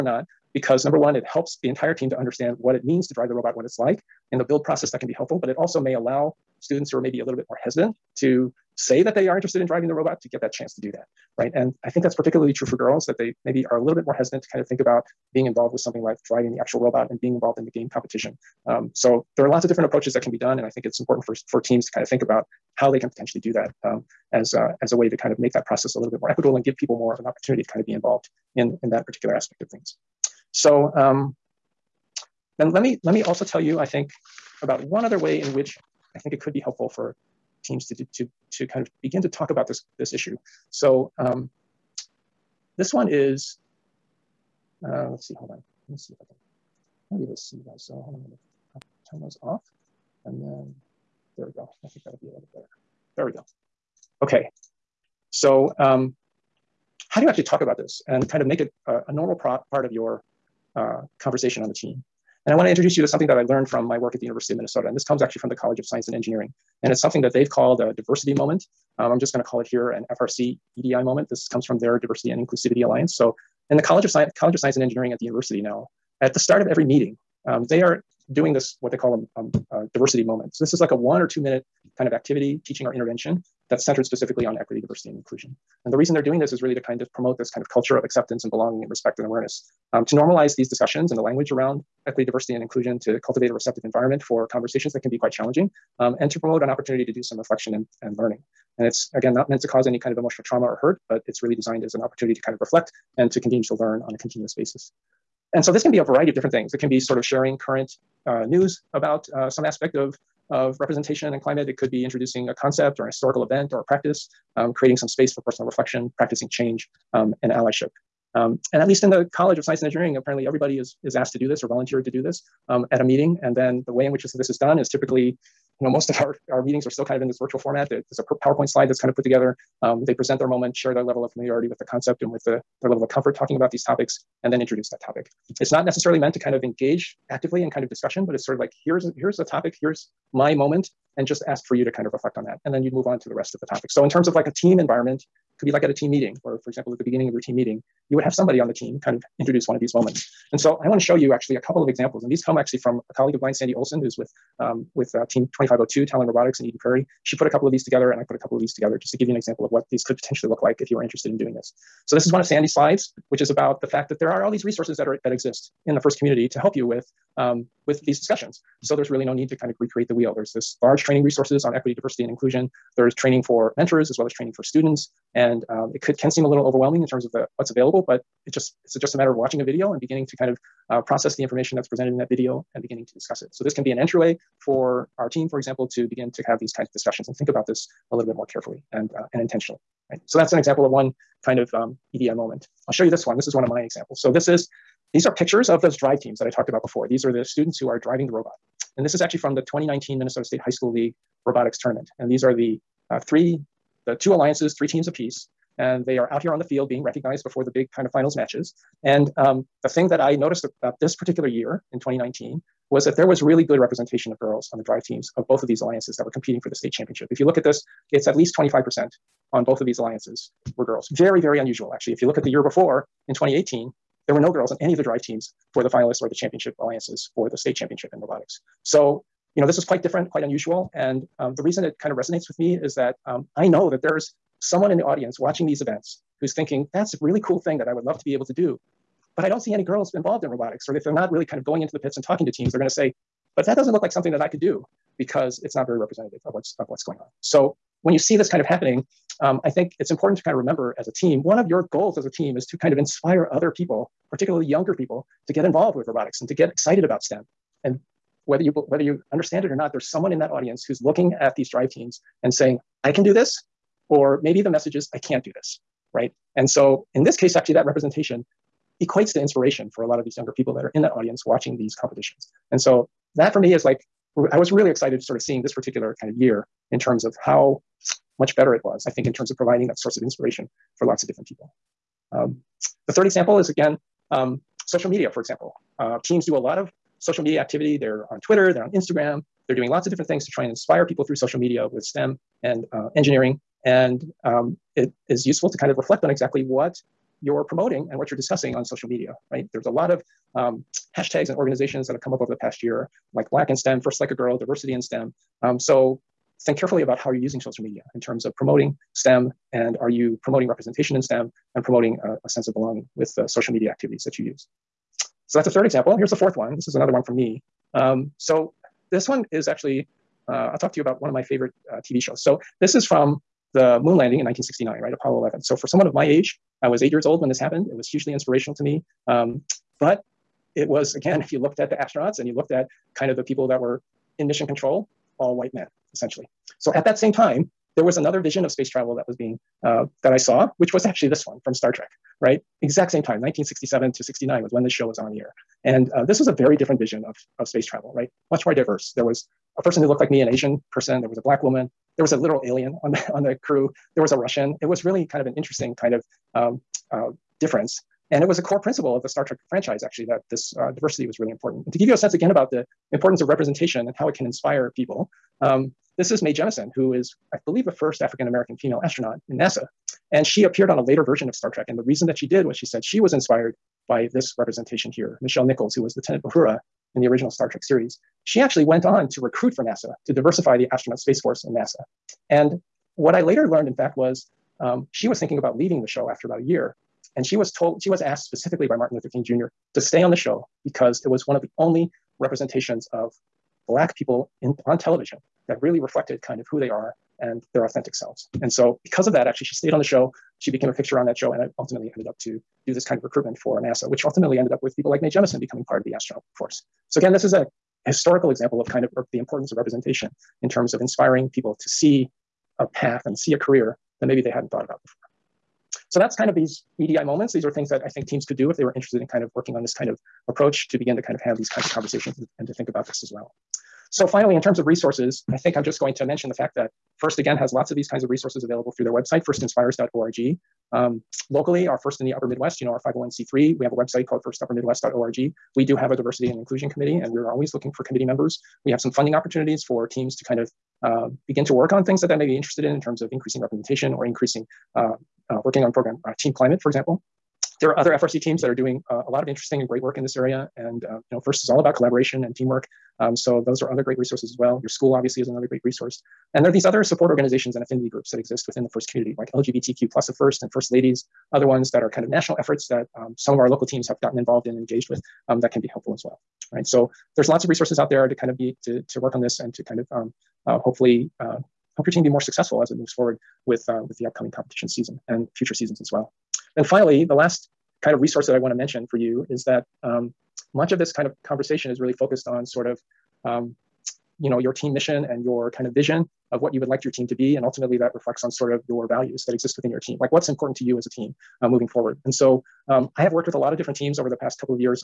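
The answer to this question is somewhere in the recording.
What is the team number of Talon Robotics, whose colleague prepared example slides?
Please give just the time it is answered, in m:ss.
2:35.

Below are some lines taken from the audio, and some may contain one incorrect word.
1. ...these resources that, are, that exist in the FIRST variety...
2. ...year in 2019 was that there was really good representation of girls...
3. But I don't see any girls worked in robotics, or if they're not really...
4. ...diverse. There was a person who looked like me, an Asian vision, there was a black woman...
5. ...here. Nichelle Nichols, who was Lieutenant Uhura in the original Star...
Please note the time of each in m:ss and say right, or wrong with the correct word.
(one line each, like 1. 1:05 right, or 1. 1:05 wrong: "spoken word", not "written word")
1. 2:44 wrong: "community", not "variety"
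2. 3:31 right
3. 3:59 wrong: "involved", not "worked"
4. 5:48 wrong: "person", not "vision"
5. 6:15 right.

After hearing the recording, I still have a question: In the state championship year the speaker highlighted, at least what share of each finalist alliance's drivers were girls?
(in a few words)
25%.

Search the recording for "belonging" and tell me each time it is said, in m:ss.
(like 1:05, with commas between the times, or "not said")
1:28, 5:12.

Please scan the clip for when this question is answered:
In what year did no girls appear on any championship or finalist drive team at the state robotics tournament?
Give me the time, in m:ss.
3:43.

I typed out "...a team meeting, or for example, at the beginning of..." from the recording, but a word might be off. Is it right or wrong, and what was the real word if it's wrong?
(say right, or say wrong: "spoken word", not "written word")
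right.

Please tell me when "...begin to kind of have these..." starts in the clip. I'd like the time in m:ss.
7:00.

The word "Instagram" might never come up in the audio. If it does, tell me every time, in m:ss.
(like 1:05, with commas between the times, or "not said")
4:48.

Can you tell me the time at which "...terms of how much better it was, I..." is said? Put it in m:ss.
4:36.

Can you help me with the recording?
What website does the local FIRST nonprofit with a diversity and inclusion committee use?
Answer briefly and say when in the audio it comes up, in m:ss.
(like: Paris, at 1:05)
firstuppermidwest.org, at 7:14.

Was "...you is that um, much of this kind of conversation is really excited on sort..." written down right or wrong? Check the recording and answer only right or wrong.
wrong.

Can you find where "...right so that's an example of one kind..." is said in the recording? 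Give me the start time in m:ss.
3:10.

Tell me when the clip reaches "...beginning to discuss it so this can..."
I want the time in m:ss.
3:02.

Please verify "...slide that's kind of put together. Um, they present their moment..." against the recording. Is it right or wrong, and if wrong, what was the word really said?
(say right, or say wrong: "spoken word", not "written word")
right.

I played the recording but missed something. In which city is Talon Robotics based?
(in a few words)
Eden Prairie.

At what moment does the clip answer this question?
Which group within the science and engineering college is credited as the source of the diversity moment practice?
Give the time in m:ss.
1:11.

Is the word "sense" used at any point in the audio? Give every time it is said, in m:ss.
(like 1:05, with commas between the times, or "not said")
5:12, 6:02.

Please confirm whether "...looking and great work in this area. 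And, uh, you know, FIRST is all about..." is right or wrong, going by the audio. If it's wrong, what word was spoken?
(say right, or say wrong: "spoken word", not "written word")
wrong: "interesting", not "looking".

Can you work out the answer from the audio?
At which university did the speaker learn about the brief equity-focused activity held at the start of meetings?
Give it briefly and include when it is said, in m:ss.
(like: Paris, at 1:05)
University of Minnesota, at 1:04.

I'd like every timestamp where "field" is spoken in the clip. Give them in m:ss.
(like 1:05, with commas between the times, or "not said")
3:26.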